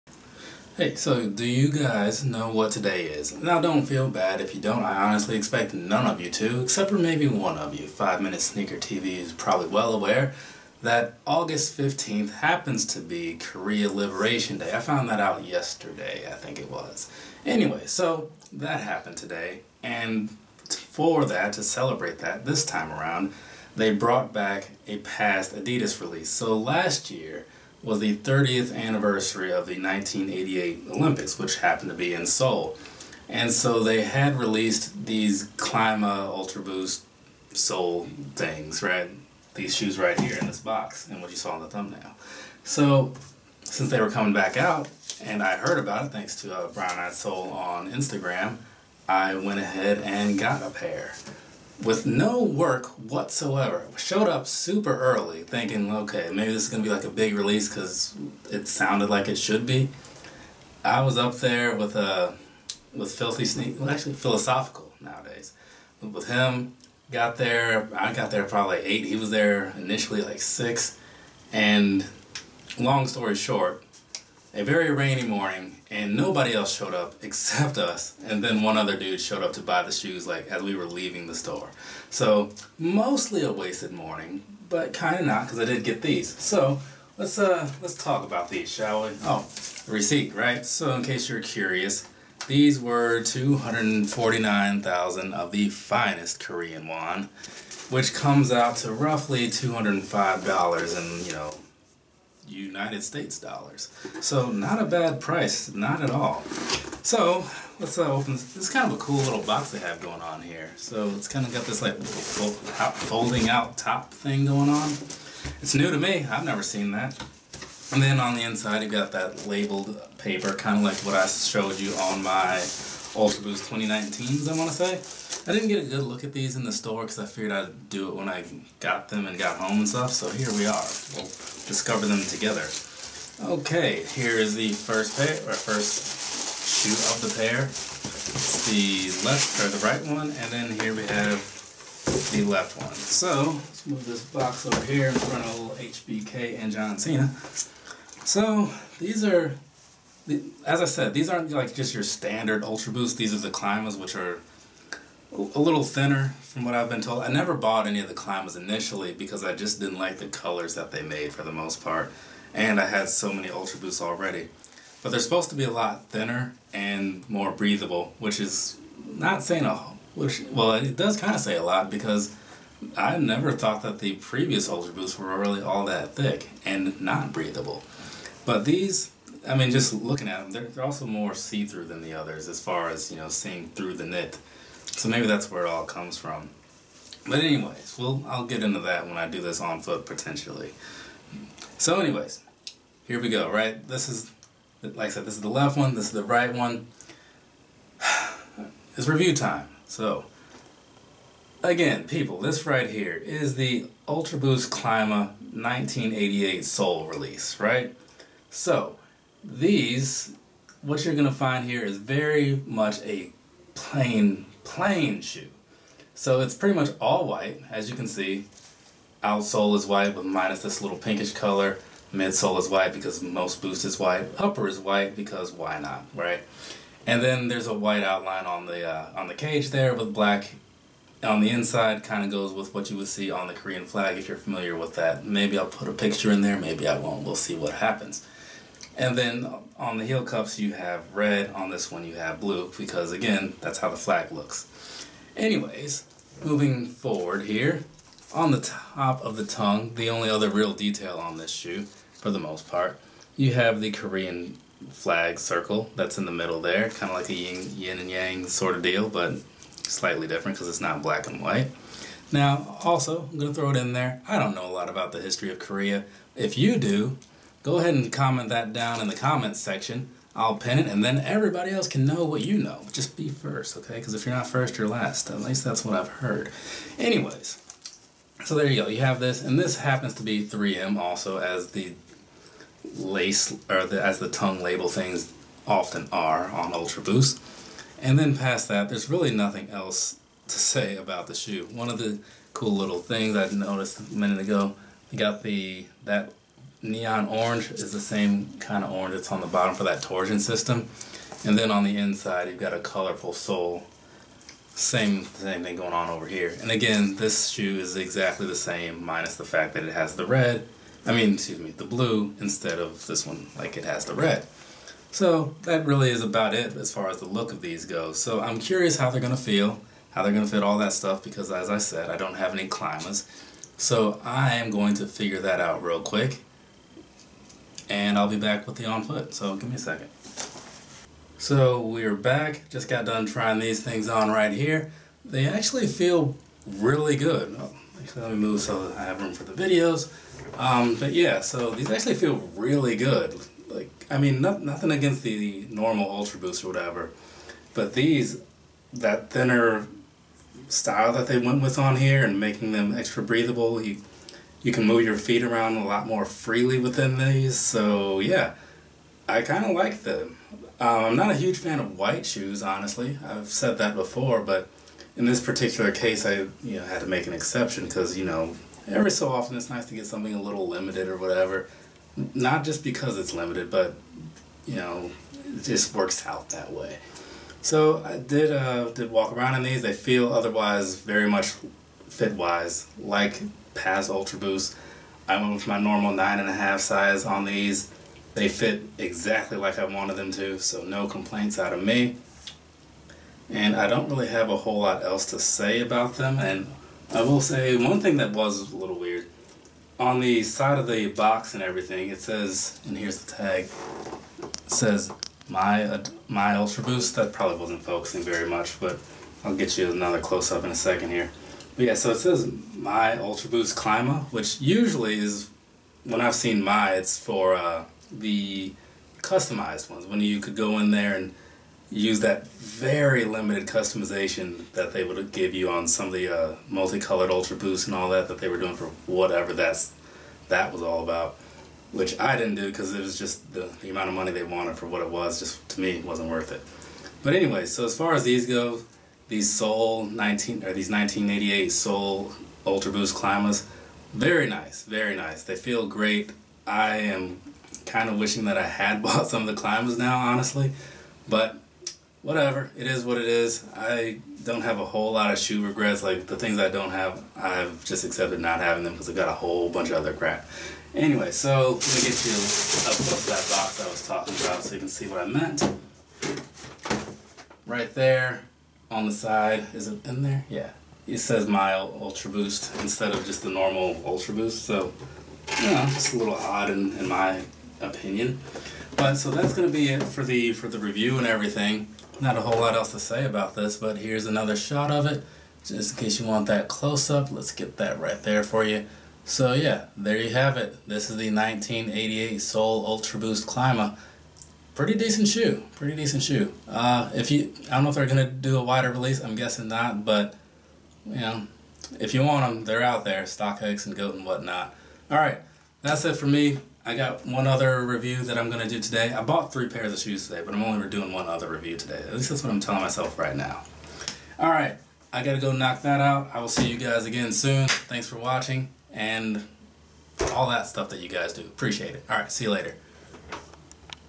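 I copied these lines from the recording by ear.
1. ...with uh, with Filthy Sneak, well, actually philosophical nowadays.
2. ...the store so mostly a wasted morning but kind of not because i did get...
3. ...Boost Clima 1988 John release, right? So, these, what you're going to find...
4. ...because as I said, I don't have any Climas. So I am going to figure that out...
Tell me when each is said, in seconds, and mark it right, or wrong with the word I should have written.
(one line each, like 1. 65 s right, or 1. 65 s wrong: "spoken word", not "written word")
1. 61 s right
2. 81 s right
3. 204 s wrong: "Seoul", not "John"
4. 321 s right.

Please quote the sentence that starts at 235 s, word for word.
Maybe I'll put a picture in there.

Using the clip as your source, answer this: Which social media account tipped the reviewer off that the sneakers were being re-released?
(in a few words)
Brown Eyed Soul.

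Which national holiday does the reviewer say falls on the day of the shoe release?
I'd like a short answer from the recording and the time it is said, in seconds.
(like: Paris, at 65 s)
Korea Liberation Day, at 13 s.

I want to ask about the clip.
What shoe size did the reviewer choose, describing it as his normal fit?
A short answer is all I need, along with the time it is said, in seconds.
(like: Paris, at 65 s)
9.5, at 386 s.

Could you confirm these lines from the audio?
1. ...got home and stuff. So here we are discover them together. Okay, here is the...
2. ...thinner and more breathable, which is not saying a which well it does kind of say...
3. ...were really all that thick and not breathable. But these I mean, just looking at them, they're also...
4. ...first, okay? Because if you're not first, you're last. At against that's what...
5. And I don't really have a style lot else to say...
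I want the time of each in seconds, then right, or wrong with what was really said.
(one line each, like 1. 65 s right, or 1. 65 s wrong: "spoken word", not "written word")
1. 129 s right
2. 166 s right
3. 175 s right
4. 273 s wrong: "least", not "against"
5. 393 s wrong: "whole", not "style".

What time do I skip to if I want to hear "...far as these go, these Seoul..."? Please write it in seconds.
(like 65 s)
437 s.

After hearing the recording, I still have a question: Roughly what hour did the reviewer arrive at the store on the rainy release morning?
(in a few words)
8.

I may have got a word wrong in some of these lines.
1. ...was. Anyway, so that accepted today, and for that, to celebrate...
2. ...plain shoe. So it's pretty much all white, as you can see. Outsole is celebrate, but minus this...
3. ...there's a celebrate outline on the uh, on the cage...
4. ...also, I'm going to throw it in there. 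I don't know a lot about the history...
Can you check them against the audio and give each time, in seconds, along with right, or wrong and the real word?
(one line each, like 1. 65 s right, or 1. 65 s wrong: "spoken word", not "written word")
1. 16 s wrong: "happened", not "accepted"
2. 214 s wrong: "white", not "celebrate"
3. 227 s wrong: "white", not "celebrate"
4. 262 s right.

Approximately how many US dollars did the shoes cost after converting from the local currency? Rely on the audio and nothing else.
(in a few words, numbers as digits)
$205.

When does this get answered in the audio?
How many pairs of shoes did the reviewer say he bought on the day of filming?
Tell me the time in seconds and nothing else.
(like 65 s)
509 s.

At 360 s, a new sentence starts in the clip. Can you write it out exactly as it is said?
Um, I'm not a huge fan of white shoes, honestly.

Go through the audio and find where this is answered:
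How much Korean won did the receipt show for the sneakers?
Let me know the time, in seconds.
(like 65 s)
93 s.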